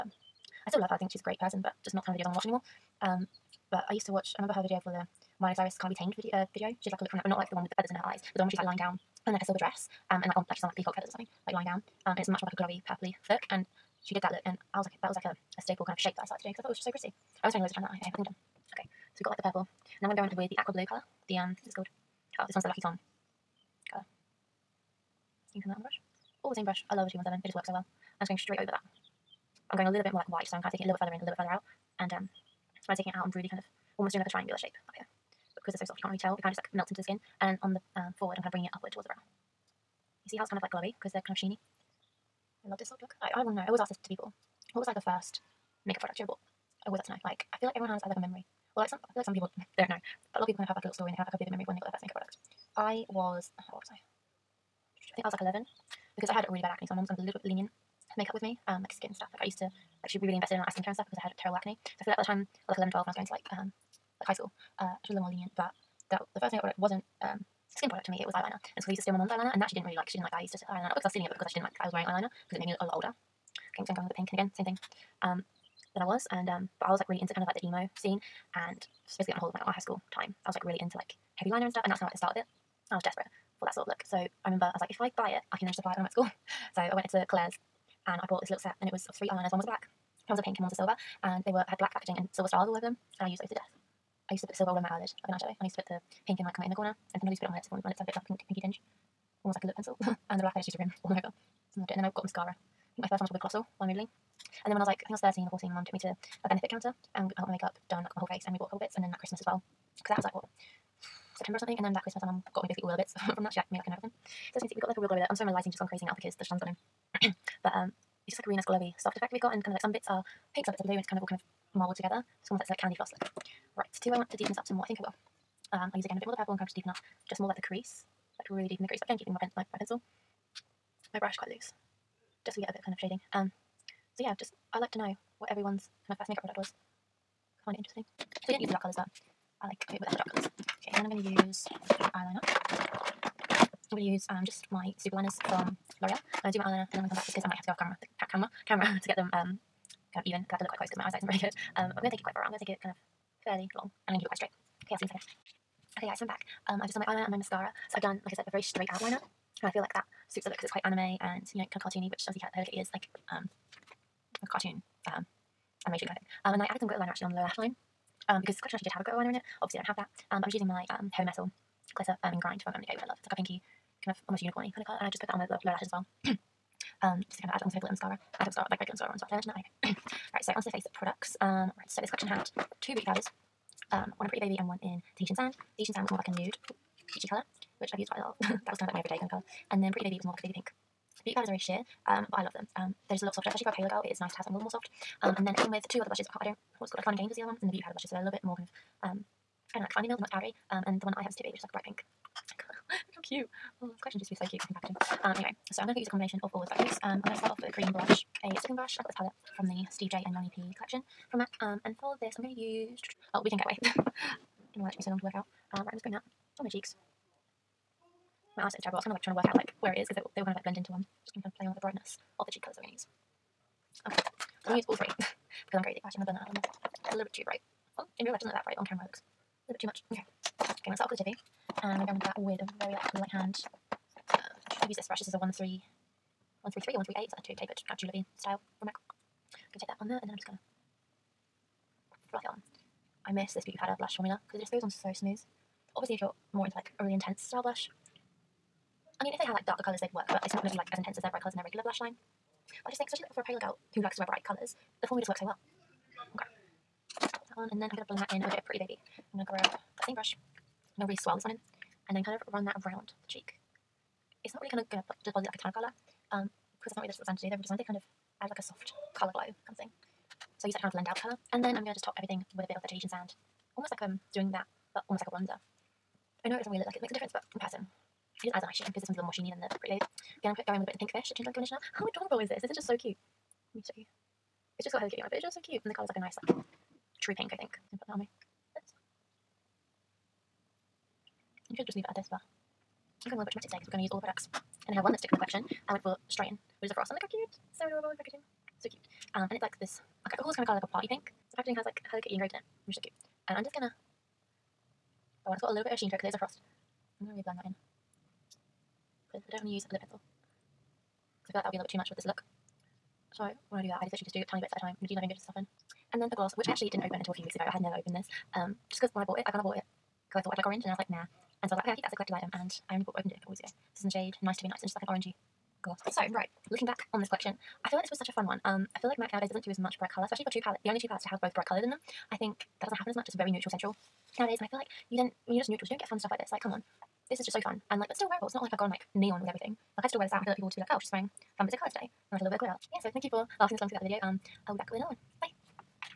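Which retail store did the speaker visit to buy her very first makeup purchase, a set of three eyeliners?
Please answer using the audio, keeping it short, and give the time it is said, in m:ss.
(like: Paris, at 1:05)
Claire's, at 1:27.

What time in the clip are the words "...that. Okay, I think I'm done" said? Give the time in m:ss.
0:17.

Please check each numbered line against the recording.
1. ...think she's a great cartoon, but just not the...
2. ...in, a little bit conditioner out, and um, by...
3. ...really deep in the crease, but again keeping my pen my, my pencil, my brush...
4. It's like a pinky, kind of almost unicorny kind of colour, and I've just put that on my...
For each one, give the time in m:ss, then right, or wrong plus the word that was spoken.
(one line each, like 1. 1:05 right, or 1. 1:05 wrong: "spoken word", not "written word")
1. 0:00 wrong: "person", not "cartoon"
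2. 0:31 wrong: "further", not "conditioner"
3. 2:08 right
4. 2:53 right.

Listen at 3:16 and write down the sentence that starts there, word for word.
I can't, I don't, what's called like Fun and Games was the other one, and the Beauty Powder blushes.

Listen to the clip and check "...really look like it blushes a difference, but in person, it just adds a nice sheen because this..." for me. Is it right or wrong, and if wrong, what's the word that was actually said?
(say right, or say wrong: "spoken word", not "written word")
wrong: "makes", not "blushes".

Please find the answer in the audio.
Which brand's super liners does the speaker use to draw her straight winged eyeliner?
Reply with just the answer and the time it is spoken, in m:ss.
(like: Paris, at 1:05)
L'Oreal, at 2:26.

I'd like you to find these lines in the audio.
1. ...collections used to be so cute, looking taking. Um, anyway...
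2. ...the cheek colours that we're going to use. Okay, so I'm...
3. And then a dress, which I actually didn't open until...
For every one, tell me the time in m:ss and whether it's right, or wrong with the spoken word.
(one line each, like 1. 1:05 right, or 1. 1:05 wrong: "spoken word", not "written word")
1. 3:24 wrong: "packaging", not "taking"
2. 3:42 right
3. 5:16 wrong: "gloss", not "dress".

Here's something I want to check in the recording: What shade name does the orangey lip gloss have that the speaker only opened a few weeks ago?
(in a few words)
Nice to be Nice.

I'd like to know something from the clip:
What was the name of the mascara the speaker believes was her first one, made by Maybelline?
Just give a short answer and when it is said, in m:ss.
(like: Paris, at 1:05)
Colossal, at 1:43.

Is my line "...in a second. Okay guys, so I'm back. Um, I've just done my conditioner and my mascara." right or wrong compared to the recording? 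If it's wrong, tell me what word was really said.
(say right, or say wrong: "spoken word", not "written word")
wrong: "eyeliner", not "conditioner".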